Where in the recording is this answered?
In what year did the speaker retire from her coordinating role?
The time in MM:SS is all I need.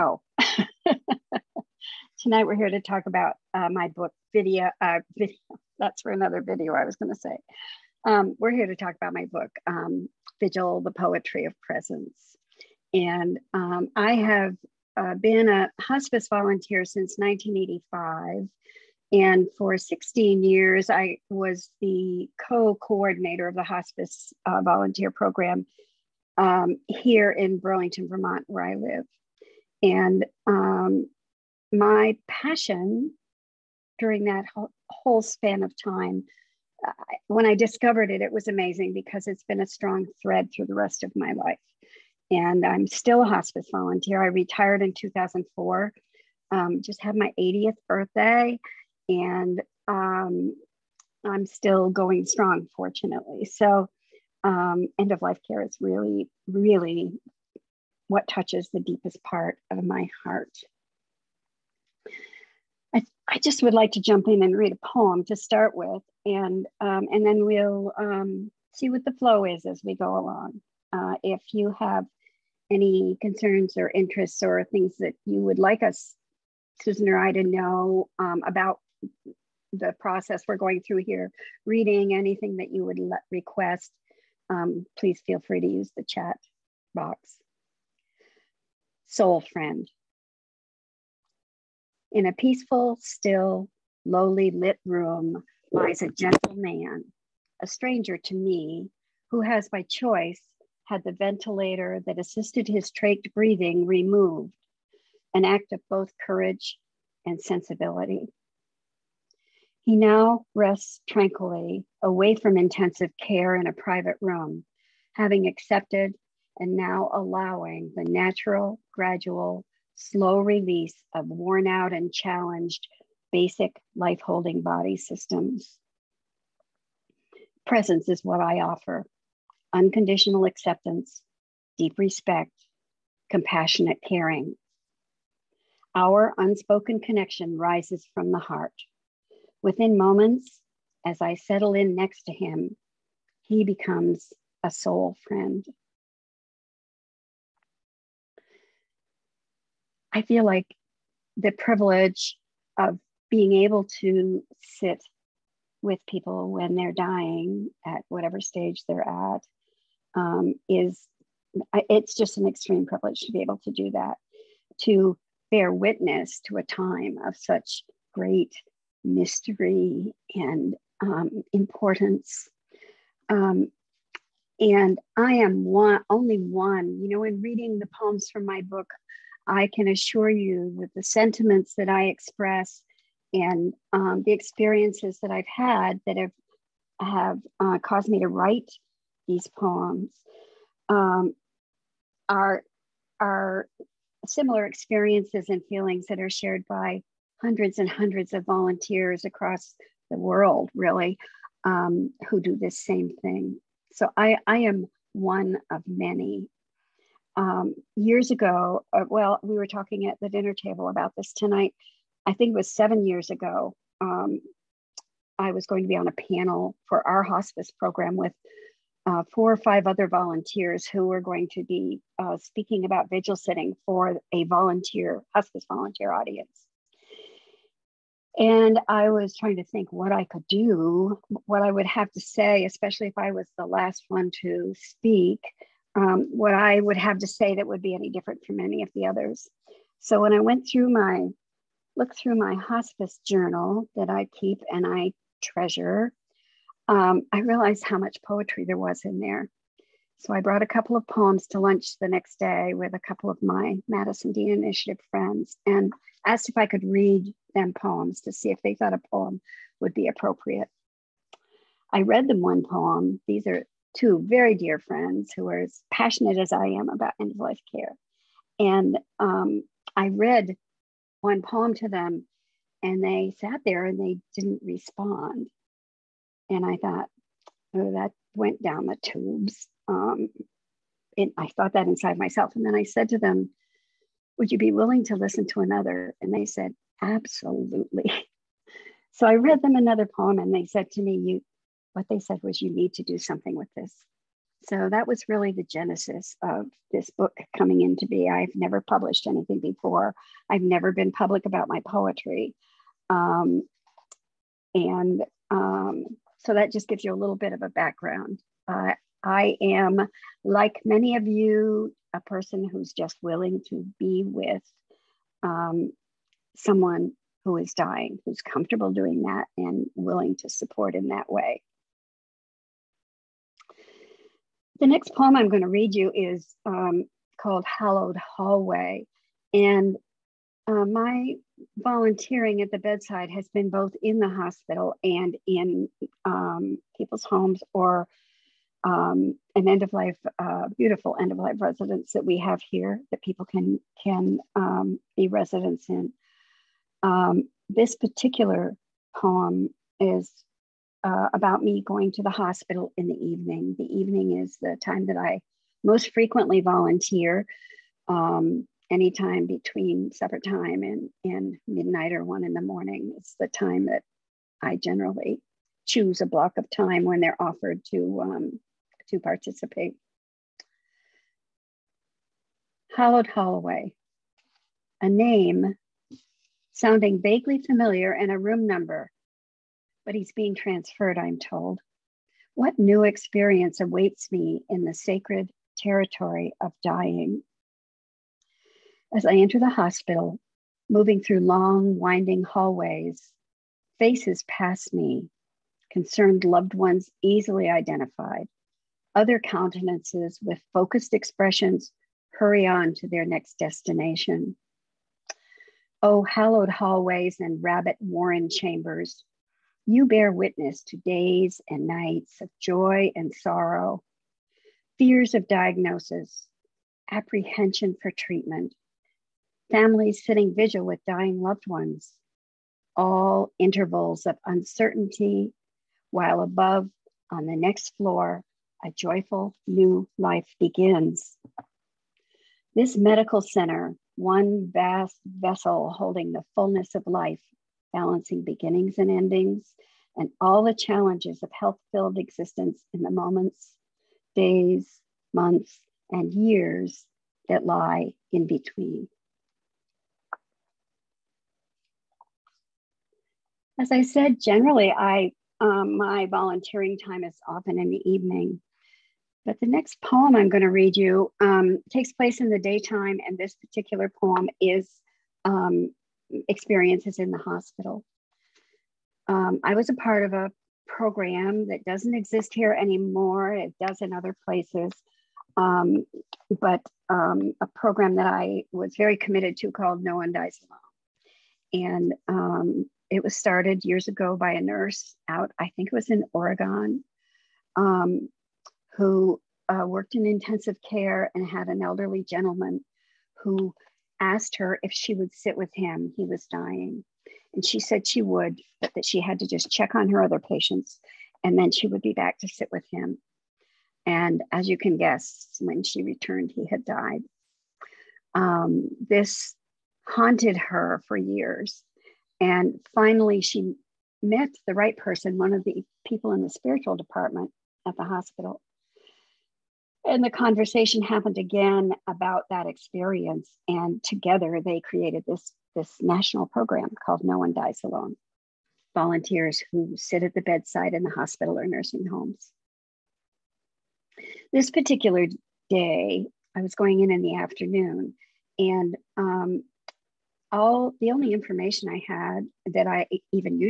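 00:44.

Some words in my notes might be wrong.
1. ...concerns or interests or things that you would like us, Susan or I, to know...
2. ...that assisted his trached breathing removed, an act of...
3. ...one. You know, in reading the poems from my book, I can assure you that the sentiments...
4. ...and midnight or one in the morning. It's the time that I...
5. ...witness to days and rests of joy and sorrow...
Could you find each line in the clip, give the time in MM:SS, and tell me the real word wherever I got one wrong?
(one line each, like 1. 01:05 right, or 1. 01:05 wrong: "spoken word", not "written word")
1. 01:13 right
2. 01:42 right
3. 02:56 right
4. 06:01 right
5. 06:50 wrong: "nights", not "rests".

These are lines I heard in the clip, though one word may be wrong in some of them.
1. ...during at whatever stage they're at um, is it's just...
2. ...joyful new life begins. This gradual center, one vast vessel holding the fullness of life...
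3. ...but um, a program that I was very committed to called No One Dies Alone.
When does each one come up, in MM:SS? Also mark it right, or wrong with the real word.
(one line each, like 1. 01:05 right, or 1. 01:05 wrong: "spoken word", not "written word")
1. 02:36 wrong: "dying", not "during"
2. 07:08 wrong: "medical", not "gradual"
3. 07:56 right.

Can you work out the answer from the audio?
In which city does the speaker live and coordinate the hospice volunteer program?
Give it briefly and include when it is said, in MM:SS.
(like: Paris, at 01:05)
Burlington, Vermont, at 00:27.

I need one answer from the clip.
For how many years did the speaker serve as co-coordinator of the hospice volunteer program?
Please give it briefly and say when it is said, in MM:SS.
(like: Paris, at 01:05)
16, at 00:19.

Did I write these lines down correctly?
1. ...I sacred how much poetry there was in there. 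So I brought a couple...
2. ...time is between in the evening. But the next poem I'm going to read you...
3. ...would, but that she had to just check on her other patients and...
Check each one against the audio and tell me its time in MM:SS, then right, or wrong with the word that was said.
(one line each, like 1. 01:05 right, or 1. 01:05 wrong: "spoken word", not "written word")
1. 04:07 wrong: "realized", not "sacred"
2. 07:36 wrong: "often", not "between"
3. 08:18 right.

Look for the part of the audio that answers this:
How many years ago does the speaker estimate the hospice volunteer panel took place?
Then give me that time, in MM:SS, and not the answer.
03:32.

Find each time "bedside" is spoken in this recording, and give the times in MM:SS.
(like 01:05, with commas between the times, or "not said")
05:32, 08:50.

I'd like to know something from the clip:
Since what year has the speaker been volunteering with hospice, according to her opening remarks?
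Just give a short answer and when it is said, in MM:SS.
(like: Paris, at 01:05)
1985, at 00:17.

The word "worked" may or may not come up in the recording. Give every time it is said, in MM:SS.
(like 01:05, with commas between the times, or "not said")
08:09.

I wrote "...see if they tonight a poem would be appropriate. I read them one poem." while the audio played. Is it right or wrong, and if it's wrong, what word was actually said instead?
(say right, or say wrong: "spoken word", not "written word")
wrong: "thought", not "tonight".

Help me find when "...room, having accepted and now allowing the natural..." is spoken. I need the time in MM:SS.
01:54.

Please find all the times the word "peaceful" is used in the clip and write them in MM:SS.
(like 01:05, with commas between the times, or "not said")
01:32.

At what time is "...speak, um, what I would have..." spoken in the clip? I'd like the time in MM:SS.
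03:54.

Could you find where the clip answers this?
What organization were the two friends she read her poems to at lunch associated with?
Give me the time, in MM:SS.
04:13.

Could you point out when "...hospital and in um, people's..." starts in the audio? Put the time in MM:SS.
05:34.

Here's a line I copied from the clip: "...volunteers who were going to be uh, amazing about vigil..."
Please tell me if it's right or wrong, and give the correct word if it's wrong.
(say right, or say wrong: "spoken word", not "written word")
wrong: "speaking", not "amazing".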